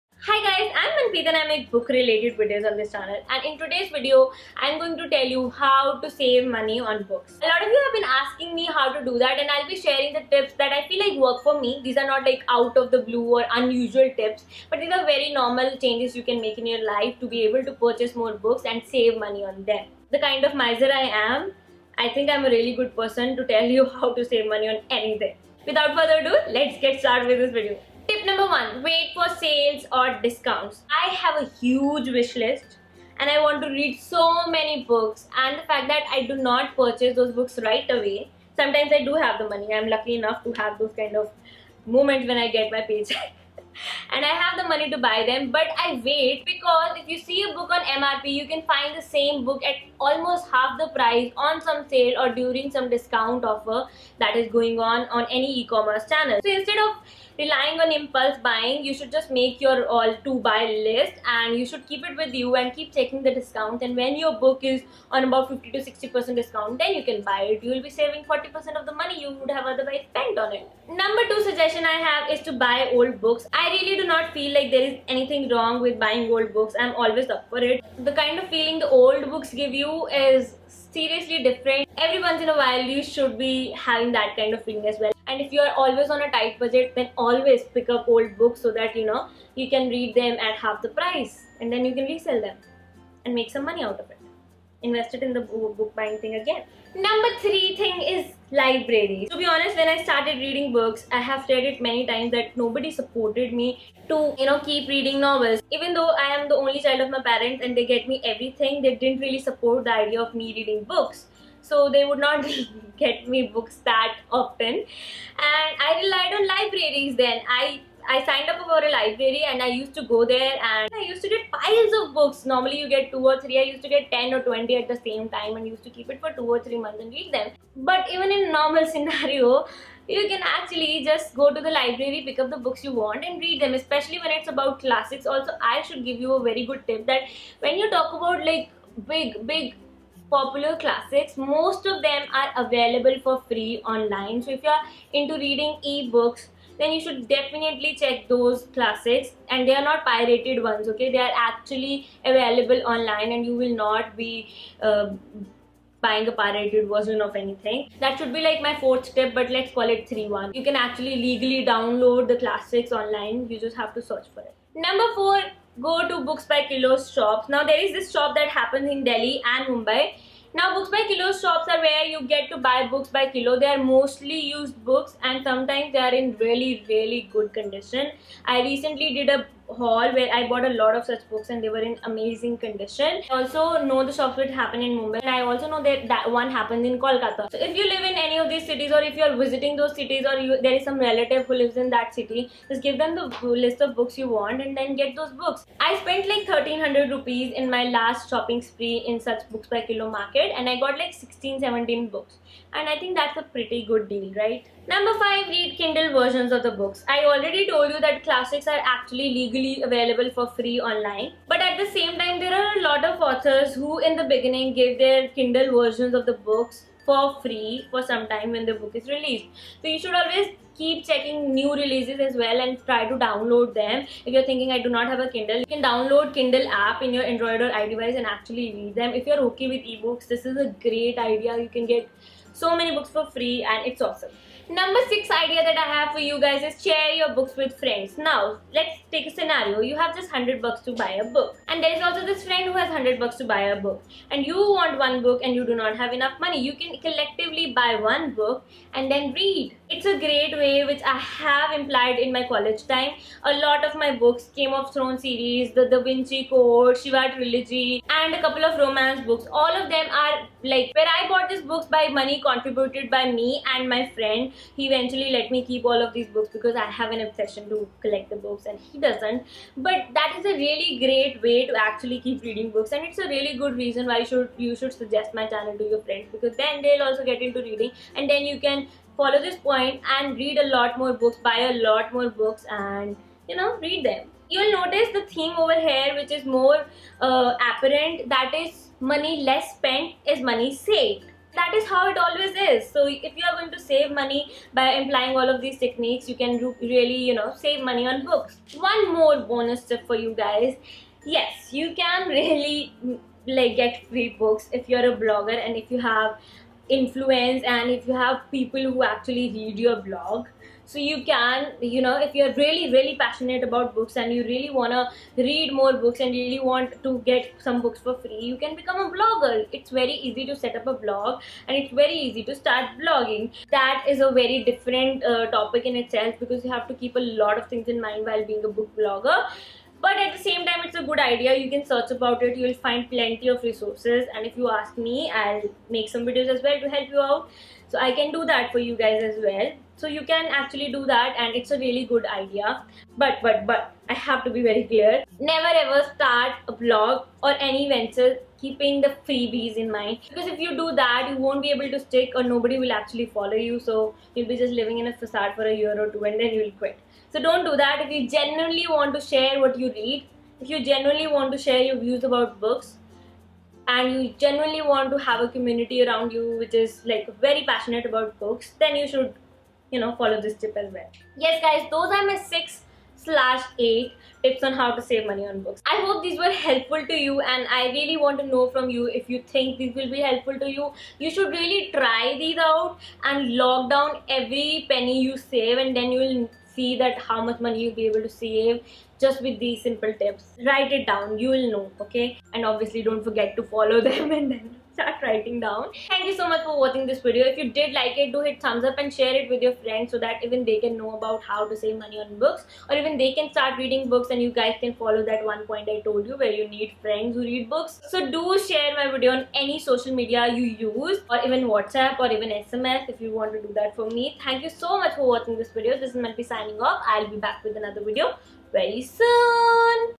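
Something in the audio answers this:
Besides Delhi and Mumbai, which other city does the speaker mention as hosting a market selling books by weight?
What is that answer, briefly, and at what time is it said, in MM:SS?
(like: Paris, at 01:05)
Kolkata, at 03:06.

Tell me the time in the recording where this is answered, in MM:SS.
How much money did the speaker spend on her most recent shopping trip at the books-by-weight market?
03:16.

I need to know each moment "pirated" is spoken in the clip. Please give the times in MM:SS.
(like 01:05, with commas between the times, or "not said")
02:30, 02:36.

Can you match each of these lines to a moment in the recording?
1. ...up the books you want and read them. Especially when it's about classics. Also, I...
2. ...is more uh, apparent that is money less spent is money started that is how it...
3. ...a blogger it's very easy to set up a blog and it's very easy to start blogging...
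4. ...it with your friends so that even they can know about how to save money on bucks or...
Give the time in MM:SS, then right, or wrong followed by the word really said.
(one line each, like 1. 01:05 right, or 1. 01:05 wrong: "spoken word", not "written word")
1. 02:12 right
2. 04:46 wrong: "saved", not "started"
3. 05:19 right
4. 06:39 wrong: "books", not "bucks".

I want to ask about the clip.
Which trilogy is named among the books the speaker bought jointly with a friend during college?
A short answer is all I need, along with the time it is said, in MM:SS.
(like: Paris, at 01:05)
Shiva trilogy, at 04:16.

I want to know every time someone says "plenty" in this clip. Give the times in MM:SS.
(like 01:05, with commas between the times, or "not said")
05:33.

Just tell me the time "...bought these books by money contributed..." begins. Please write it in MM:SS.
04:21.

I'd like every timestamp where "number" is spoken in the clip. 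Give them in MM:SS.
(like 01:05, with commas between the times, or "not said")
00:28, 01:10, 01:36, 02:44, 03:24, 03:54.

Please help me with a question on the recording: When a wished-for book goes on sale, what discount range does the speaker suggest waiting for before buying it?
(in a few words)
50 to 60%.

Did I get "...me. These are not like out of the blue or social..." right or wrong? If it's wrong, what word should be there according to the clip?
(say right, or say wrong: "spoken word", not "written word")
wrong: "unusual", not "social".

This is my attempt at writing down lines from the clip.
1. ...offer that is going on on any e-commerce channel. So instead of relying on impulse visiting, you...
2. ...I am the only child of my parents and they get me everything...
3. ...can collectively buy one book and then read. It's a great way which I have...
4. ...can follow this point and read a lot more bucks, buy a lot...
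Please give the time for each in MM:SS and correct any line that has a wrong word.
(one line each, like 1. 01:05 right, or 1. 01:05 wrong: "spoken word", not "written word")
1. 00:53 wrong: "buying", not "visiting"
2. 01:46 right
3. 04:06 right
4. 04:38 wrong: "books", not "bucks".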